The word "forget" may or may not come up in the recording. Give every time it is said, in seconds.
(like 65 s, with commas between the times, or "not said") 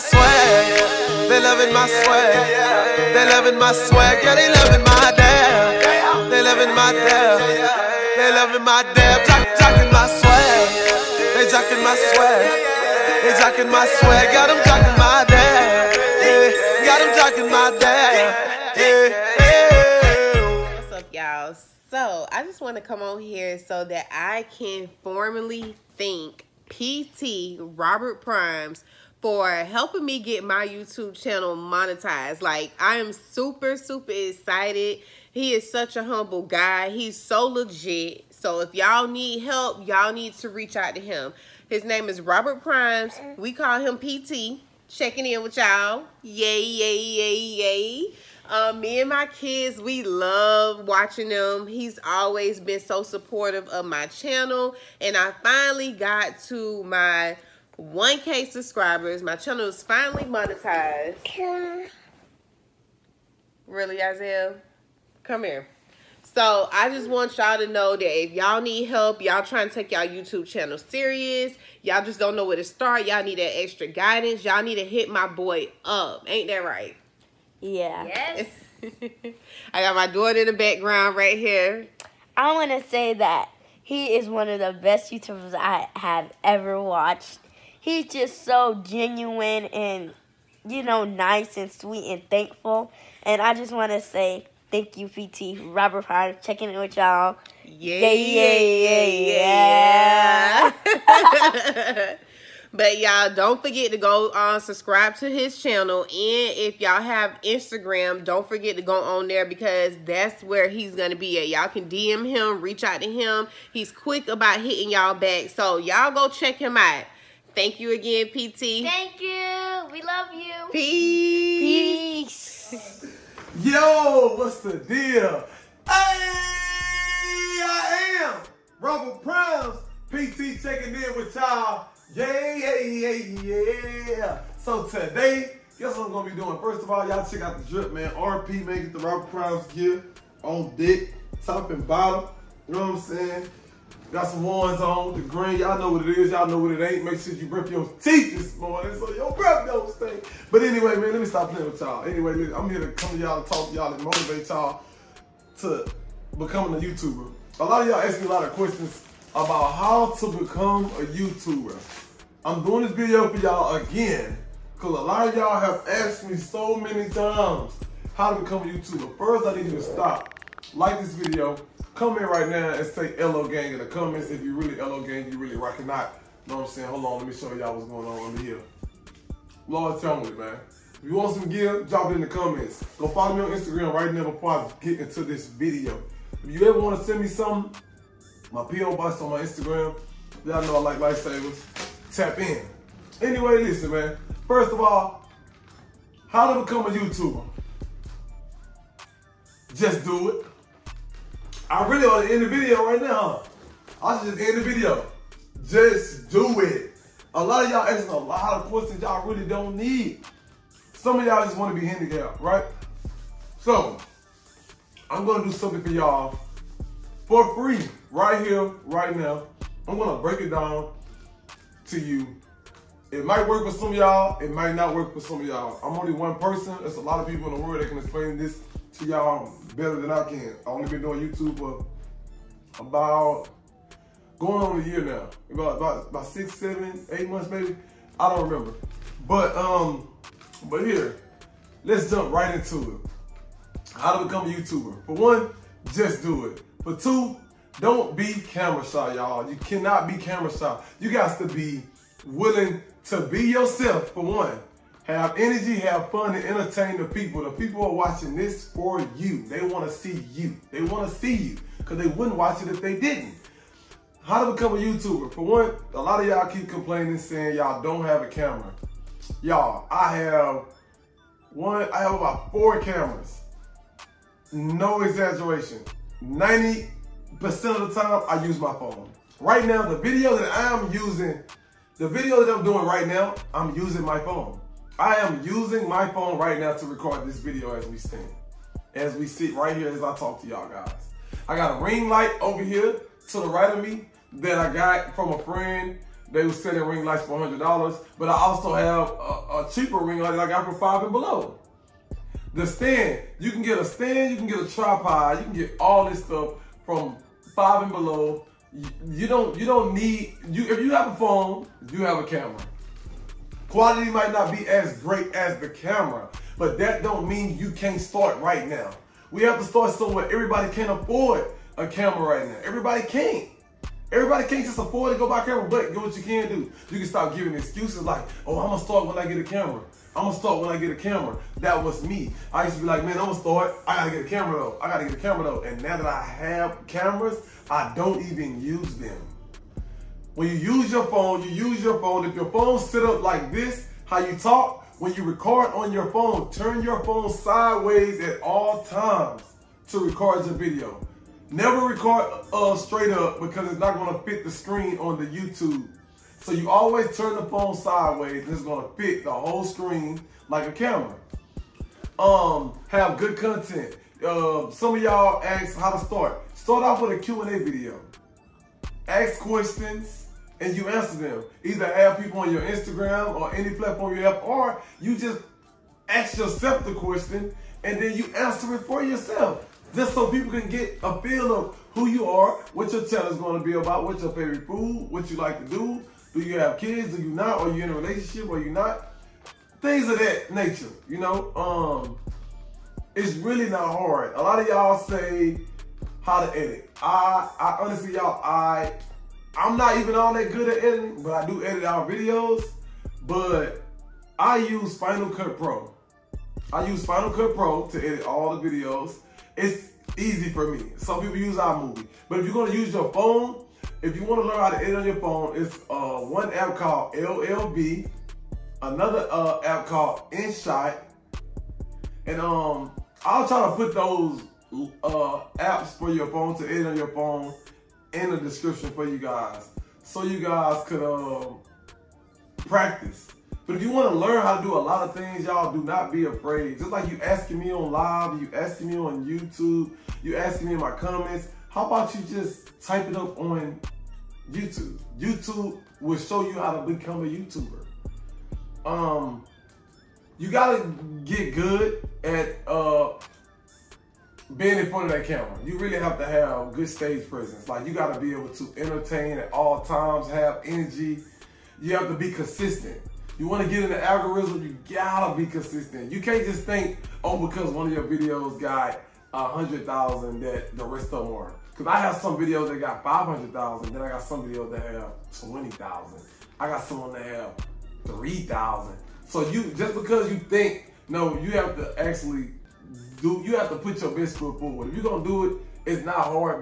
103 s, 108 s.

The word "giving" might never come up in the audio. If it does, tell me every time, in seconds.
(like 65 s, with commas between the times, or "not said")
327 s.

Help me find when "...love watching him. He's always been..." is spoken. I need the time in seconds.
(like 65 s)
50 s.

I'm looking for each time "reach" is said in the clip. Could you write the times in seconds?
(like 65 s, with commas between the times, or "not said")
40 s, 112 s.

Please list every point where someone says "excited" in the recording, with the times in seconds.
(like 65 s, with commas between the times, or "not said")
34 s.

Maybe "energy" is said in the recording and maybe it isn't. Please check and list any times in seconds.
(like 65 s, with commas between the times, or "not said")
255 s, 460 s.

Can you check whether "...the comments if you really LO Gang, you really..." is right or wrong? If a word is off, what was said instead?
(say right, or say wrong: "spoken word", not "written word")
right.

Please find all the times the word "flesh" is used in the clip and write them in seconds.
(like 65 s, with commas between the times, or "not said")
not said.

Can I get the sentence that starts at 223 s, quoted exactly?
It might work for some of y'all, it might not work for some of y'all.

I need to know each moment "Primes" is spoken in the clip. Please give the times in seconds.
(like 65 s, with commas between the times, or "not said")
28 s, 42 s, 96 s, 129 s.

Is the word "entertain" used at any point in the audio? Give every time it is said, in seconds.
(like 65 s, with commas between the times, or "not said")
256 s, 458 s.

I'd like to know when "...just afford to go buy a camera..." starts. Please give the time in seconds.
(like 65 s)
324 s.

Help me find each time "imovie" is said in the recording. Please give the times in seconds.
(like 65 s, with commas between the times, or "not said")
411 s.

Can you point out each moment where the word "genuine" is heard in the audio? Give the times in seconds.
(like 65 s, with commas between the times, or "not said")
88 s.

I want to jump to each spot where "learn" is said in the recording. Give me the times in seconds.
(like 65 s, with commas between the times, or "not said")
414 s, 434 s.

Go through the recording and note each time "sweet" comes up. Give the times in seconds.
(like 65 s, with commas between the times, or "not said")
91 s.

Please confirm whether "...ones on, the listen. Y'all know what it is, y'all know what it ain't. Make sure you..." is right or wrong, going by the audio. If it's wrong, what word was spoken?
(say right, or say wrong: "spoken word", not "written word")
wrong: "green", not "listen".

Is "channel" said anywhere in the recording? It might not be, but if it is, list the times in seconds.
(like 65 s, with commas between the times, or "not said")
31 s, 54 s, 59 s, 70 s, 105 s, 383 s.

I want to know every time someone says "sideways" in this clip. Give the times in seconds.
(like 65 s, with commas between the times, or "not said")
347 s, 357 s.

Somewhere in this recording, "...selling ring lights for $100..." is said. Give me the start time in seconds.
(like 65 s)
296 s.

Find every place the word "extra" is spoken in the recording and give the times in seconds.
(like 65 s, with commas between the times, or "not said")
73 s.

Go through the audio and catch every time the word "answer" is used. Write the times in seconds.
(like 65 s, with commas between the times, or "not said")
370 s, 378 s.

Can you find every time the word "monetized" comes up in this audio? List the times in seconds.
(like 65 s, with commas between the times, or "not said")
31 s, 60 s.